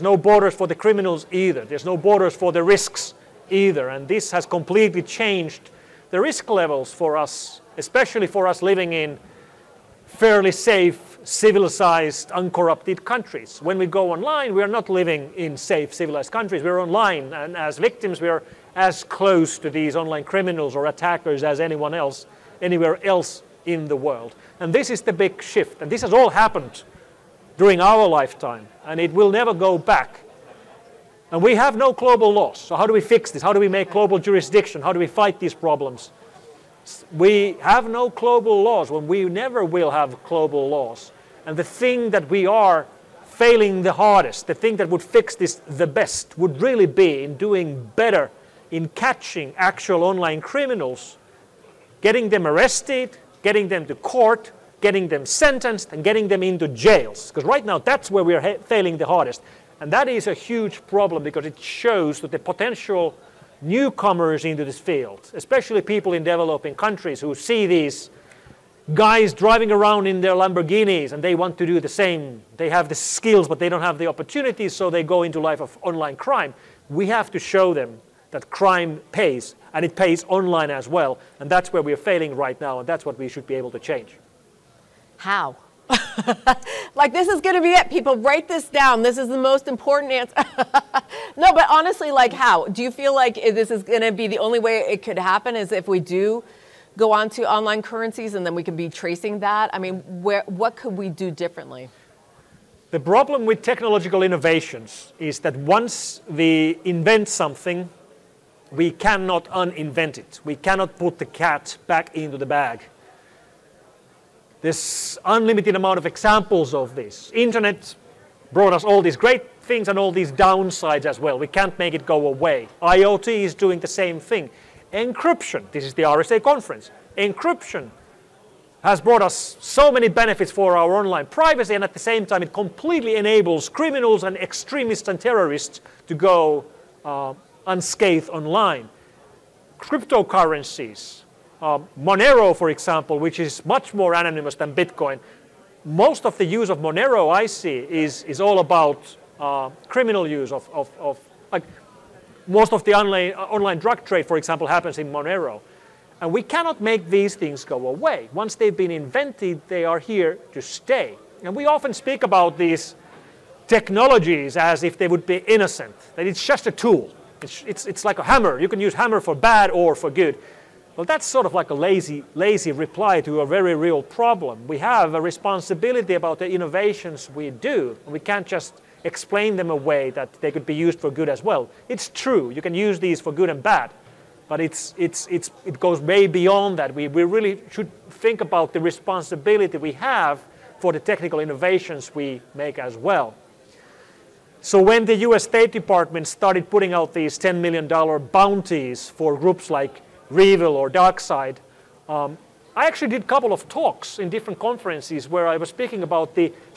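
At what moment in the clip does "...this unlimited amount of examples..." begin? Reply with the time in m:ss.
1:54.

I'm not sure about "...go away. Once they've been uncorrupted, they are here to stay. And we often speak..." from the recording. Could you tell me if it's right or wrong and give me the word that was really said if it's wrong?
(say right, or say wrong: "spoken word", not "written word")
wrong: "invented", not "uncorrupted".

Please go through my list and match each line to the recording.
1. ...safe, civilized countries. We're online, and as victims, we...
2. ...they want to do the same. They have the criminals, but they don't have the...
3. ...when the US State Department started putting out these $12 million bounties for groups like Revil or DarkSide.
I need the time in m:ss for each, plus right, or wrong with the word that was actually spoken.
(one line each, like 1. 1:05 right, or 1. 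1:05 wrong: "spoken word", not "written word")
1. 0:15 right
2. 1:11 wrong: "skills", not "criminals"
3. 3:14 wrong: "10", not "12".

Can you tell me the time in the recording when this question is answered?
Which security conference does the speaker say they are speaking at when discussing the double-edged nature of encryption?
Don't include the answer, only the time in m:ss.
2:06.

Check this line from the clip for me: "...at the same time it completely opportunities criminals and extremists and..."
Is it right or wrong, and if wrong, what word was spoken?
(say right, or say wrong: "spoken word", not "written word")
wrong: "enables", not "opportunities".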